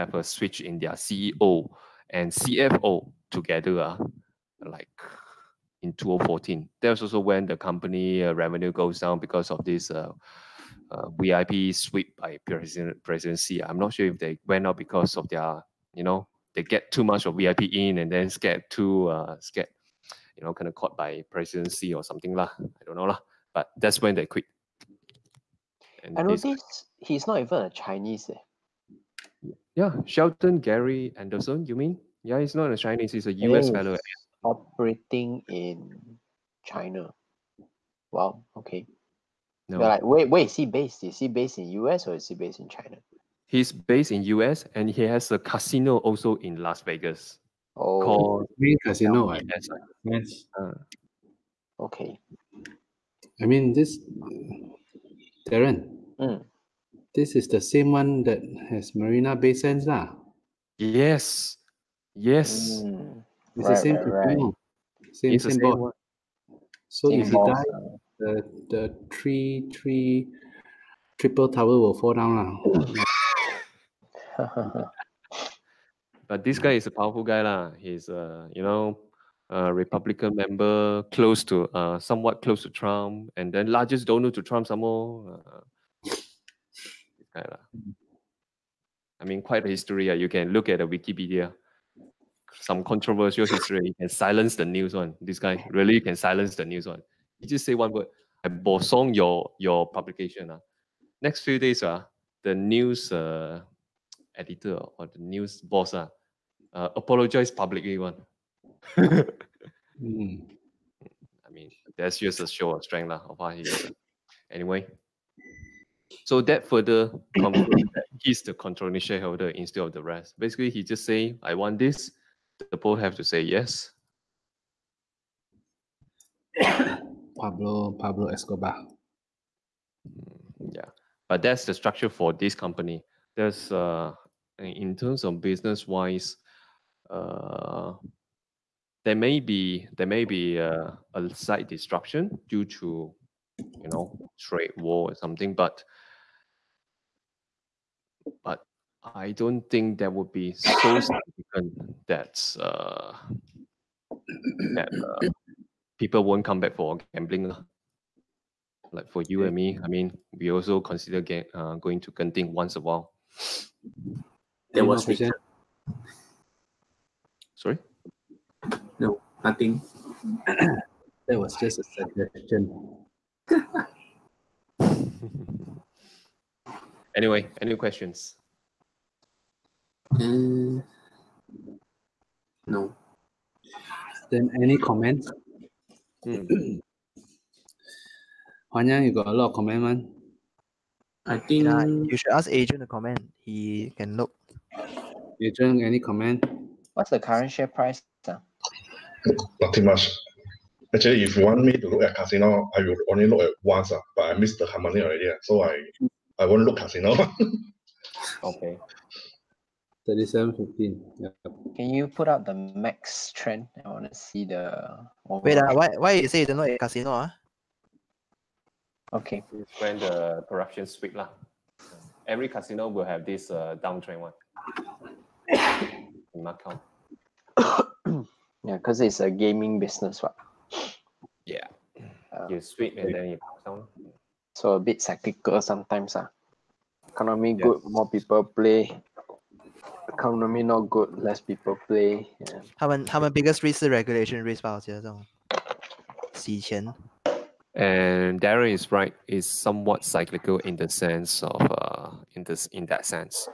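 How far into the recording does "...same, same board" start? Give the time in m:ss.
1:05.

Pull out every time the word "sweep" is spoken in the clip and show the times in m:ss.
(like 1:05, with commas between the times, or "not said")
0:11, 3:40, 3:52.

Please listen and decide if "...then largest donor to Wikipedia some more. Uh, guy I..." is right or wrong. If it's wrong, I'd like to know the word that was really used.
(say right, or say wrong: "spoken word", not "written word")
wrong: "Trump", not "Wikipedia".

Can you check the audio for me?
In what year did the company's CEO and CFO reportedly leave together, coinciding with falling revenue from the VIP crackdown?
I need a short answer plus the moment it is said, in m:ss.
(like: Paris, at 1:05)
2014, at 0:05.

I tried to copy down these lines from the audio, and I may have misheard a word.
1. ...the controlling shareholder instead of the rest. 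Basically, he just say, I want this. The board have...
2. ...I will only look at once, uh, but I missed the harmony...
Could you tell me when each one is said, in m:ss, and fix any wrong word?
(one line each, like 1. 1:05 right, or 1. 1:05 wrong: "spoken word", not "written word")
1. 1:58 right
2. 3:22 right.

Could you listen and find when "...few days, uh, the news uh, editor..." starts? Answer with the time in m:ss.
1:41.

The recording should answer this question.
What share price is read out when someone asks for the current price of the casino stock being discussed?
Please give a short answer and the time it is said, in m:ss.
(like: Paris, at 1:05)
37.15, at 3:30.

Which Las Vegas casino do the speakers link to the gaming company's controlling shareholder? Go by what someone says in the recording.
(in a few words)
Main Casino.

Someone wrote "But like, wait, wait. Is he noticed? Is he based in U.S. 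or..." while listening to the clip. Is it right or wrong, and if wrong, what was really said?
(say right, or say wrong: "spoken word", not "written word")
wrong: "based", not "noticed".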